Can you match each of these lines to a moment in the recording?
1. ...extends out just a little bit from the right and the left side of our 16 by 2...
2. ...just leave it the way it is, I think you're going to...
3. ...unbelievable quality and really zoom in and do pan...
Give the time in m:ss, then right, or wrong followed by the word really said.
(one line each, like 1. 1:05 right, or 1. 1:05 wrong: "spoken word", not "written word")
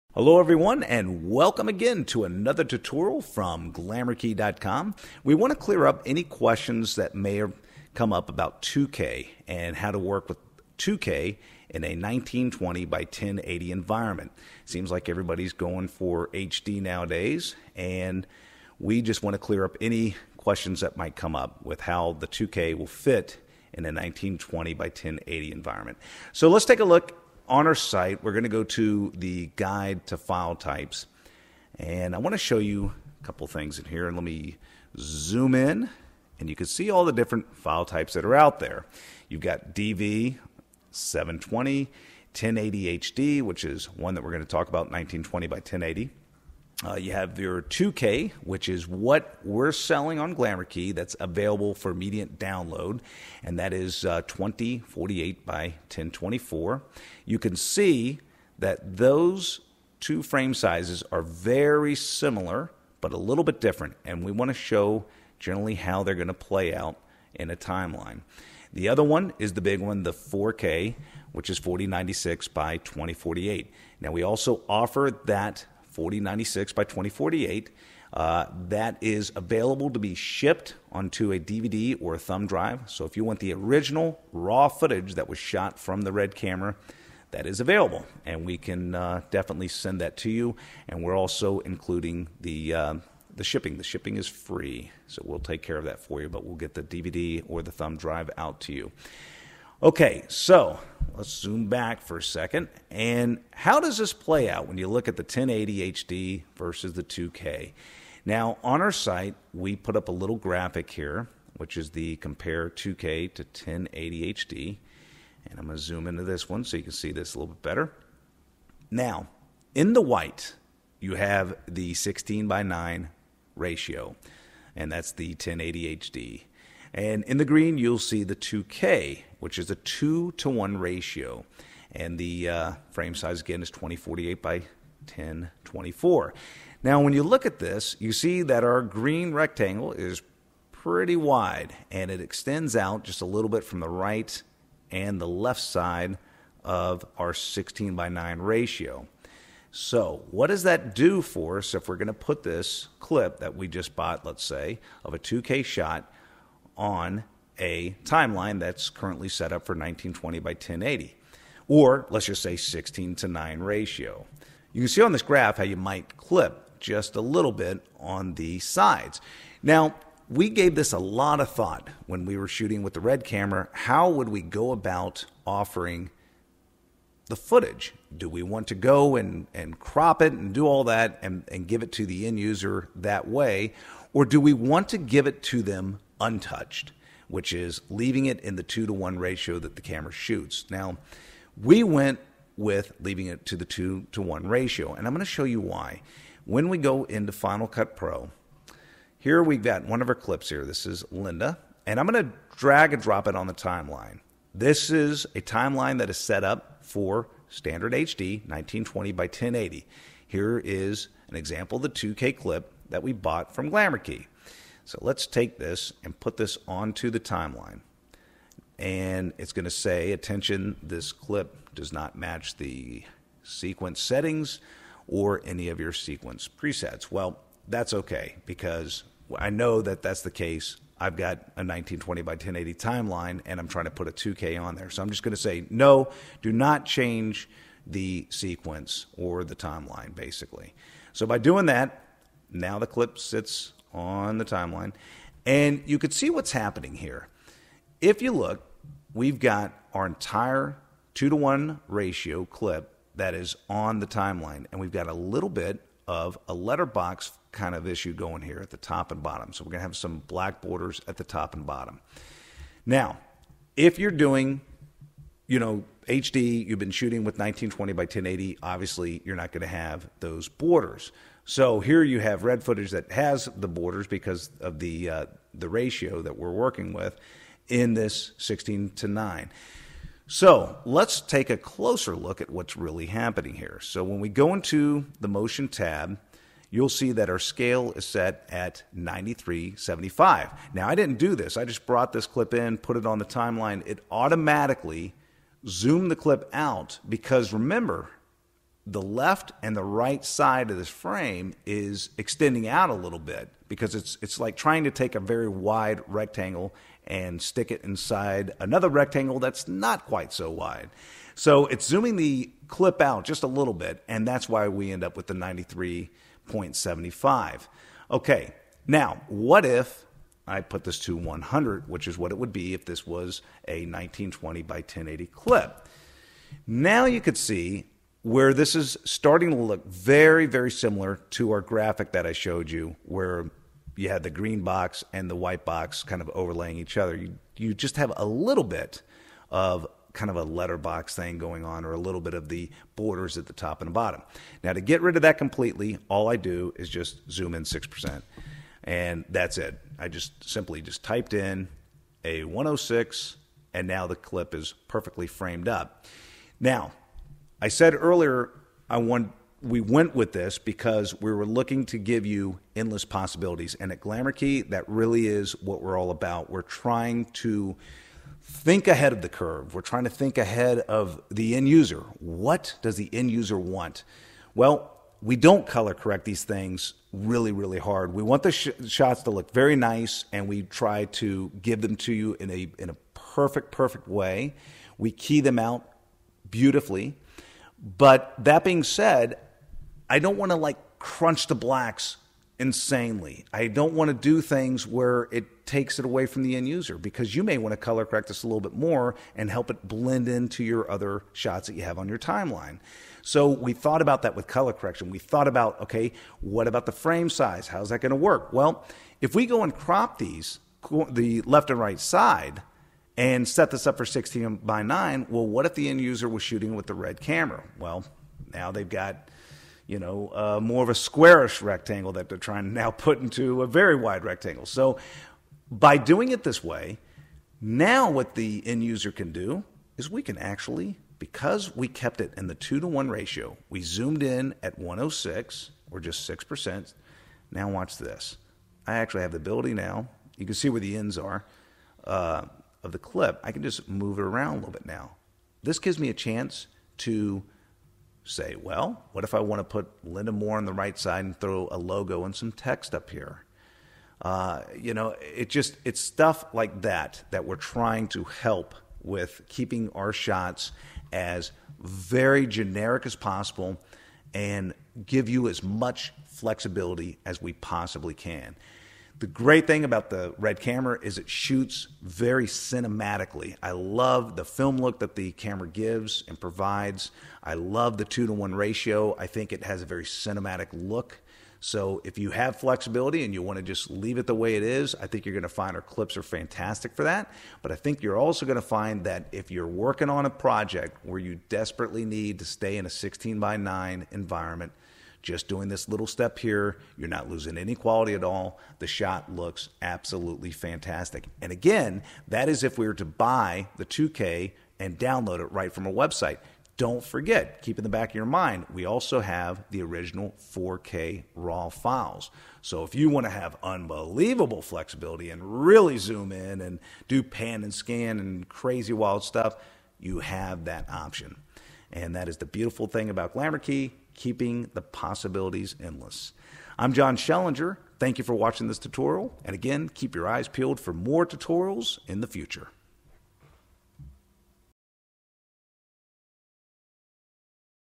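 1. 2:22 wrong: "9", not "2"
2. 8:03 right
3. 8:33 wrong: "flexibility", not "quality".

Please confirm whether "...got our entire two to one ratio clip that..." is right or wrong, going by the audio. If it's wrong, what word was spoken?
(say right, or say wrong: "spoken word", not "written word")
right.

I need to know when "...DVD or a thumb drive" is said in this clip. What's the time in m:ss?
1:21.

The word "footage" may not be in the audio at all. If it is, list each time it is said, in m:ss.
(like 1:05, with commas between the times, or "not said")
1:24, 2:57, 4:32.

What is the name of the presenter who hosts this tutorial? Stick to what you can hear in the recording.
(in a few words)
Jon Schellinger.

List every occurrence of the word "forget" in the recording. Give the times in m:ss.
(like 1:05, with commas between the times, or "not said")
8:27.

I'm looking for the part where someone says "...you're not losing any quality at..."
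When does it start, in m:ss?
8:16.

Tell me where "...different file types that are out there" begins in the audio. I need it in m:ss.
0:37.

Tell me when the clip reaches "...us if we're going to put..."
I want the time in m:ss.
2:31.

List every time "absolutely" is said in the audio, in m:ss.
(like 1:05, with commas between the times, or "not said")
8:19.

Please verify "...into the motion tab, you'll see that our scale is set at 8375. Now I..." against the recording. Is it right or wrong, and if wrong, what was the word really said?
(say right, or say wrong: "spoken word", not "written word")
wrong: "9375", not "8375".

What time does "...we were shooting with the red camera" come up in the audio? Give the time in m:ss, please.
2:52.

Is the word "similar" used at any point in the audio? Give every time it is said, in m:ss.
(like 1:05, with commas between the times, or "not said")
1:01, 5:30.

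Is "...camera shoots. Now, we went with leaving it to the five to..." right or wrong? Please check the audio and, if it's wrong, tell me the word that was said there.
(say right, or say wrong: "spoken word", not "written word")
wrong: "two", not "five".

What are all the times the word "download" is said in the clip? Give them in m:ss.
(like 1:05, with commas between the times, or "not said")
0:52, 8:24.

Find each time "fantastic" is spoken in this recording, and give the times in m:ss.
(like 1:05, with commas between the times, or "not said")
8:06, 8:20.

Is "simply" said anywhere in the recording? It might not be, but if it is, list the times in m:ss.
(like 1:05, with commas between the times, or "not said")
5:50.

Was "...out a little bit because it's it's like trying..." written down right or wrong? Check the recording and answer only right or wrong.
right.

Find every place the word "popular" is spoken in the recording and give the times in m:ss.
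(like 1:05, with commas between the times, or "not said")
not said.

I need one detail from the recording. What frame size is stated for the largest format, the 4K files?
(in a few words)
4096 by 2048.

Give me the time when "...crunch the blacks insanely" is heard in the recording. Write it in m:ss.
6:30.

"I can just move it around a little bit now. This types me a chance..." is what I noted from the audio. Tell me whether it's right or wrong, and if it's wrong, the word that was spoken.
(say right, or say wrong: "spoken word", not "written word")
wrong: "gives", not "types".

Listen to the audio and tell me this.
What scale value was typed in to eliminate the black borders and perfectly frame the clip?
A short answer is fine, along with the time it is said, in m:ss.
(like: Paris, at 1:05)
106, at 5:52.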